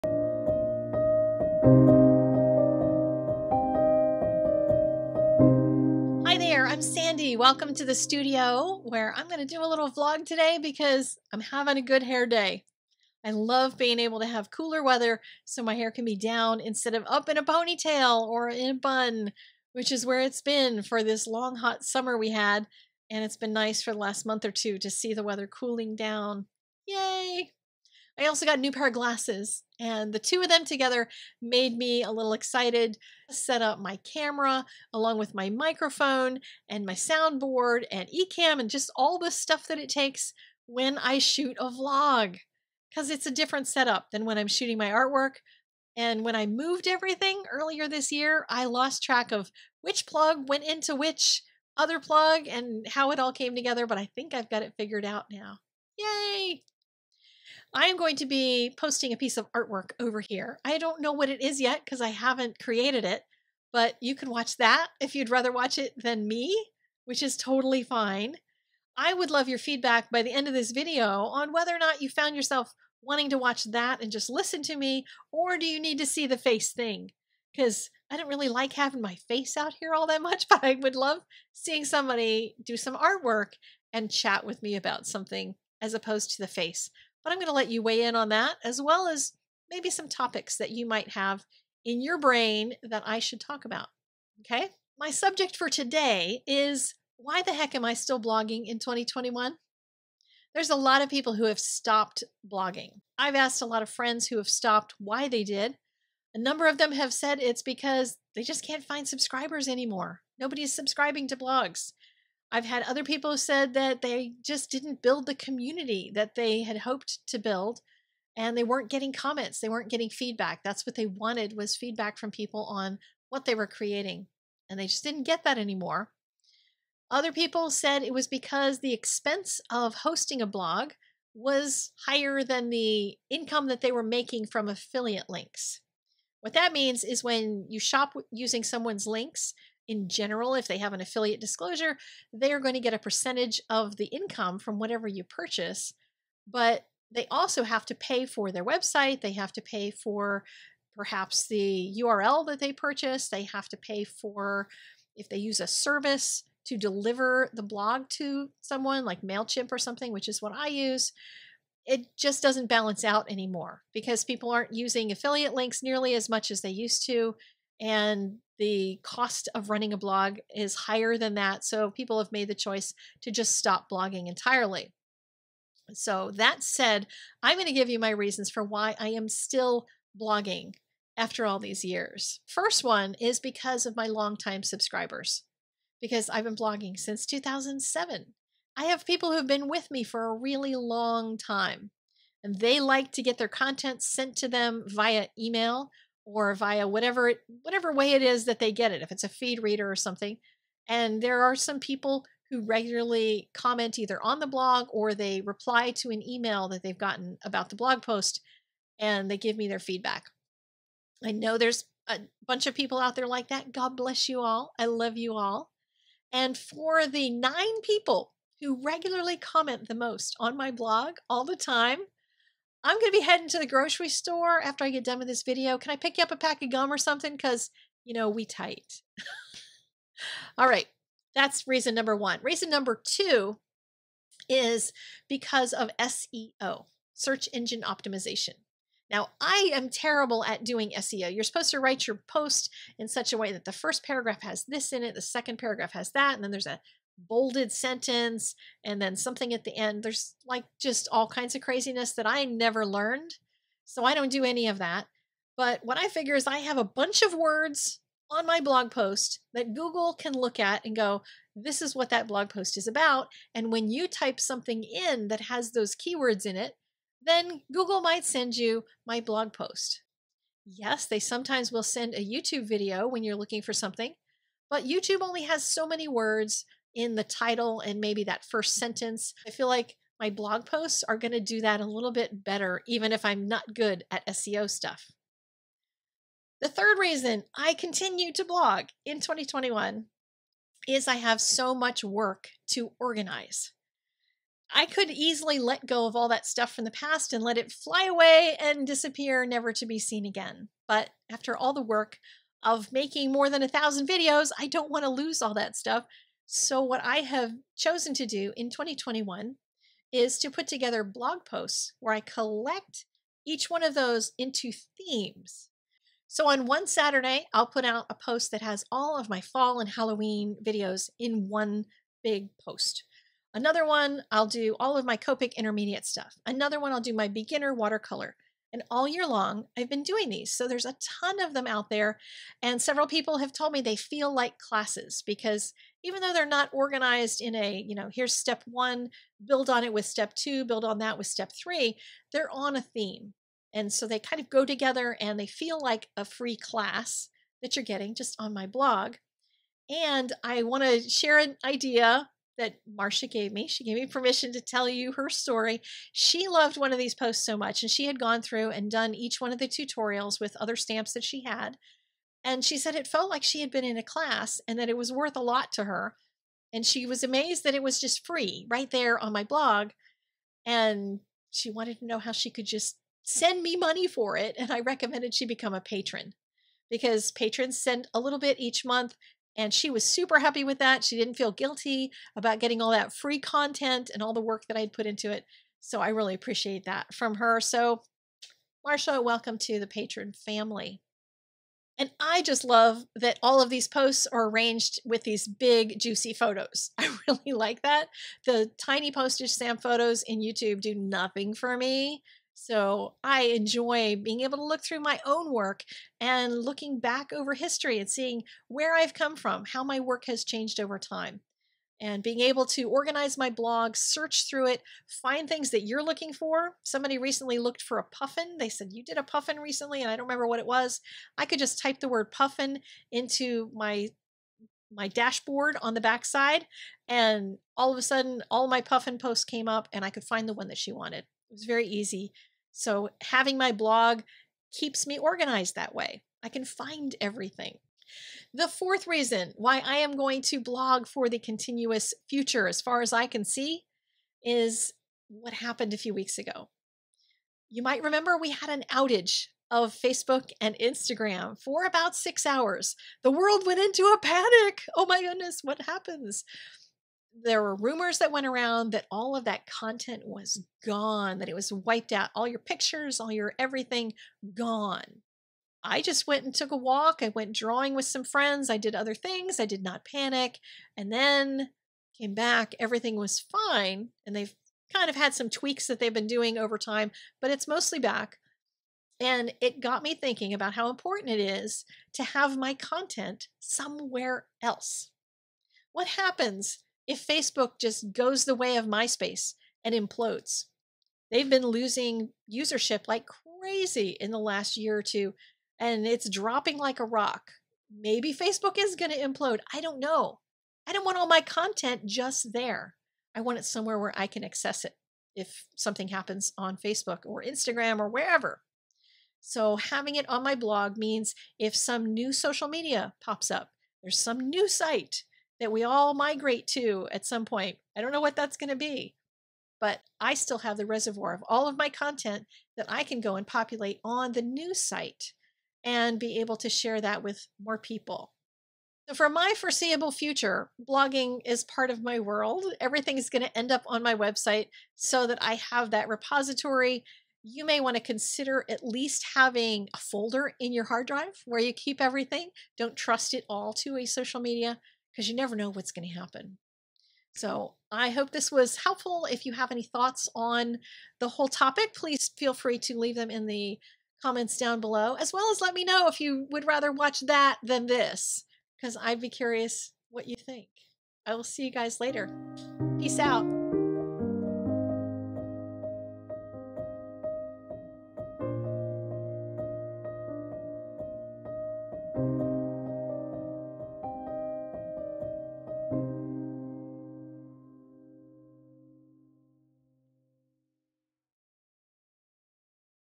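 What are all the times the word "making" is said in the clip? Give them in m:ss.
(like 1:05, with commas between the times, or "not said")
2:14, 5:02.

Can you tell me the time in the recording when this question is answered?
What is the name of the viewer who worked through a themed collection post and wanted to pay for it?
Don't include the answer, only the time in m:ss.
5:52.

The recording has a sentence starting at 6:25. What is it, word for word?
So I really appreciate that from her.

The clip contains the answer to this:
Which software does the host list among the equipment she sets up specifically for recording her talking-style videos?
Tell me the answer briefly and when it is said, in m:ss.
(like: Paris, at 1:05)
Ecamm, at 0:38.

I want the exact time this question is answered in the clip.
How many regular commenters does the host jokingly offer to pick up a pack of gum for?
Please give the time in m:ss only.
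3:37.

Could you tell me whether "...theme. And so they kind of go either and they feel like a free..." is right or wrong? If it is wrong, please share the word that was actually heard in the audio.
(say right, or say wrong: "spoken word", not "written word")
wrong: "together", not "either".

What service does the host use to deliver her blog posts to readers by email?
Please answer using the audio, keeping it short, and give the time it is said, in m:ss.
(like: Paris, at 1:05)
MailChimp, at 2:39.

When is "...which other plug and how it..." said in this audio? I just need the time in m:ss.
0:50.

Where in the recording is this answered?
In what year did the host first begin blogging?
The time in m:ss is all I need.
3:07.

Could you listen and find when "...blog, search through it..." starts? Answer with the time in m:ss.
6:53.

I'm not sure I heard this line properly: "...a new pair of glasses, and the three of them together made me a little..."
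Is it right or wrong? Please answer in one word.
wrong.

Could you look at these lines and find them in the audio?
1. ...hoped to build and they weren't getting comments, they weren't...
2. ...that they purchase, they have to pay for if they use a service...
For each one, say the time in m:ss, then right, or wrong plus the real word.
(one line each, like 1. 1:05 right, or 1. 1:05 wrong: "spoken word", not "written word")
1. 1:56 right
2. 2:32 right.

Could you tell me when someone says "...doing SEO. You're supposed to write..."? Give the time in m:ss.
4:00.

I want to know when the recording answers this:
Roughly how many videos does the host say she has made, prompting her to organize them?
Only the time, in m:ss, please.
5:03.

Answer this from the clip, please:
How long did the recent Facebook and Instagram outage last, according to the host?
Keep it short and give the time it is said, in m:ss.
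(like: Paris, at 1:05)
about 6 hours, at 7:31.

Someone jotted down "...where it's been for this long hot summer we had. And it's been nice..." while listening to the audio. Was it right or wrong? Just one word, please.
right.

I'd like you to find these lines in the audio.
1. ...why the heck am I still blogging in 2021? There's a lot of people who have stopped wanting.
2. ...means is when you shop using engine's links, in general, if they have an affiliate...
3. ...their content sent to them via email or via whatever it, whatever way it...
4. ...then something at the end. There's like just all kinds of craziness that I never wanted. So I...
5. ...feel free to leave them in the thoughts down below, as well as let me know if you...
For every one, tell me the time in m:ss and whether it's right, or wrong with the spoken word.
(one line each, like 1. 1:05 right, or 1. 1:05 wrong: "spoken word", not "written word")
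1. 1:37 wrong: "blogging", not "wanting"
2. 2:16 wrong: "someone", not "engine"
3. 3:13 right
4. 4:09 wrong: "learned", not "wanted"
5. 9:12 wrong: "comments", not "thoughts".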